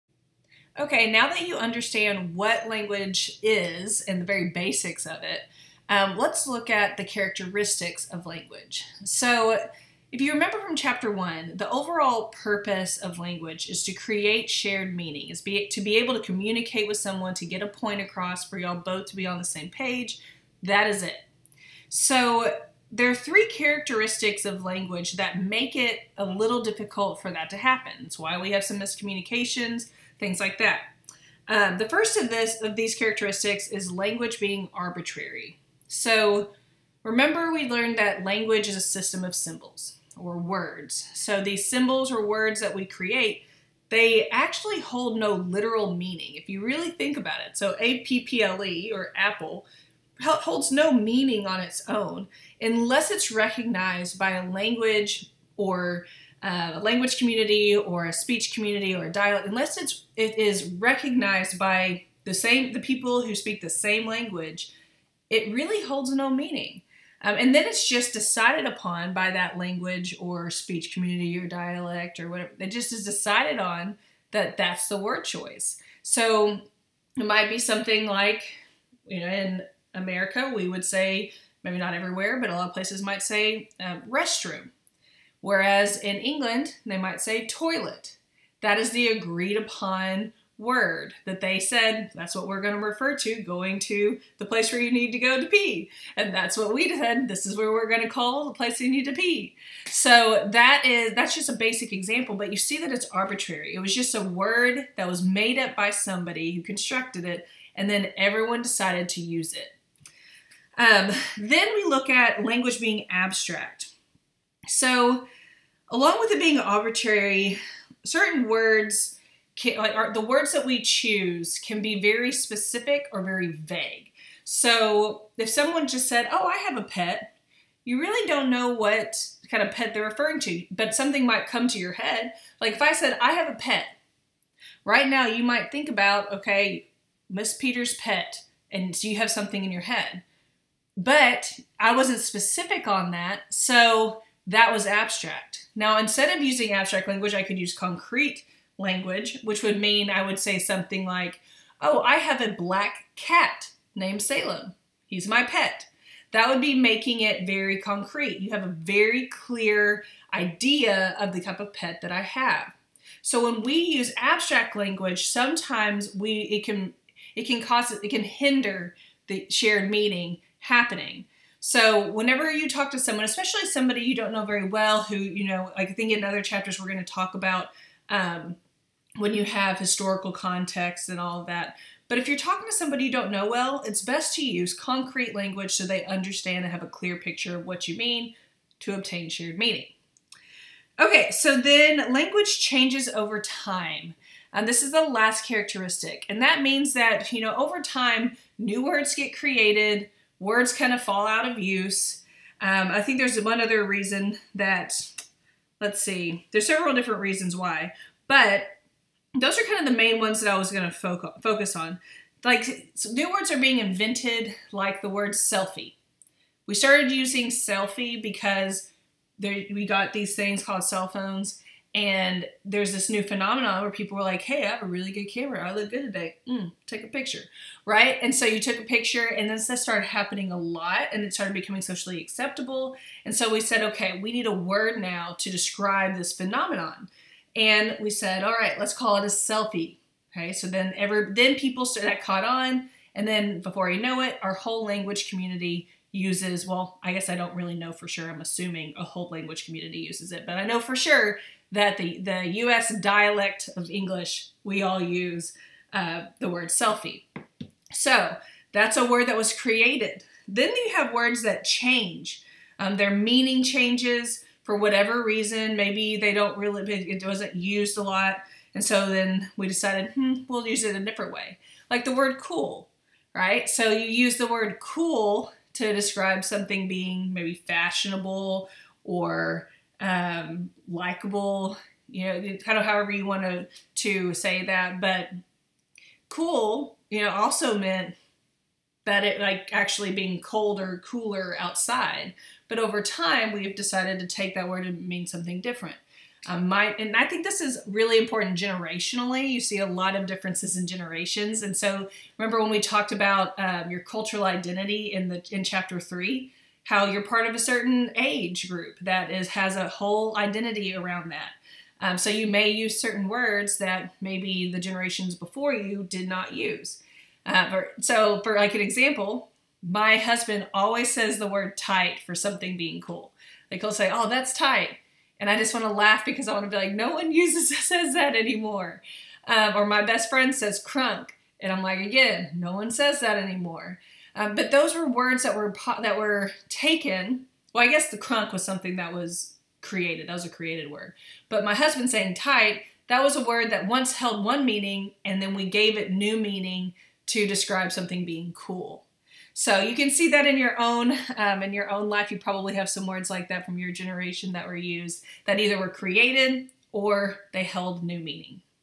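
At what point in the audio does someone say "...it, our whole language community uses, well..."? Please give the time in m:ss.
4:04.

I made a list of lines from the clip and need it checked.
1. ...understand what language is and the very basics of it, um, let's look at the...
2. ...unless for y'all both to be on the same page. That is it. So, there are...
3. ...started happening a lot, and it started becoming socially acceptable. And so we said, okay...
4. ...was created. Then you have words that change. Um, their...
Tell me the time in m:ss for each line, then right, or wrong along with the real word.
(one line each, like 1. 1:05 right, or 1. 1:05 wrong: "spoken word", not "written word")
1. 0:01 right
2. 0:18 wrong: "across", not "unless"
3. 3:49 right
4. 4:19 right.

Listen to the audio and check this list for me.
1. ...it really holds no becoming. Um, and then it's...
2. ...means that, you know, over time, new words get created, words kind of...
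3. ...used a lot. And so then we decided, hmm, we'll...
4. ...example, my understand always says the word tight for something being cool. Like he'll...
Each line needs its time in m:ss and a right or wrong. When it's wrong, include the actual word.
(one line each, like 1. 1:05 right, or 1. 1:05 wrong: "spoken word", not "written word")
1. 1:05 wrong: "meaning", not "becoming"
2. 3:16 right
3. 4:27 right
4. 5:18 wrong: "husband", not "understand".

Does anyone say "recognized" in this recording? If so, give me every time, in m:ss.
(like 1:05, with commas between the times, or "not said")
0:53, 1:00.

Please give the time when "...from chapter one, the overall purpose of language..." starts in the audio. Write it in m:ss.
0:10.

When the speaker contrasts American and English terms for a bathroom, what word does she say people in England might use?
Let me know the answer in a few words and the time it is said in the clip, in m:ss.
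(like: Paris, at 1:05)
toilet, at 1:27.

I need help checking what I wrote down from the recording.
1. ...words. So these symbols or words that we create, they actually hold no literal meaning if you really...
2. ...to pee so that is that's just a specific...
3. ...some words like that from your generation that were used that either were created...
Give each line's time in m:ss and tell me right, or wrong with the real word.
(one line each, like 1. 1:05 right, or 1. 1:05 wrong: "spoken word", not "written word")
1. 0:40 right
2. 1:39 wrong: "basic", not "specific"
3. 5:52 right.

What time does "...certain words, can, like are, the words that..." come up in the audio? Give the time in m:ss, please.
1:58.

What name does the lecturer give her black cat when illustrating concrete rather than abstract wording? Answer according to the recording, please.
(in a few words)
Salem.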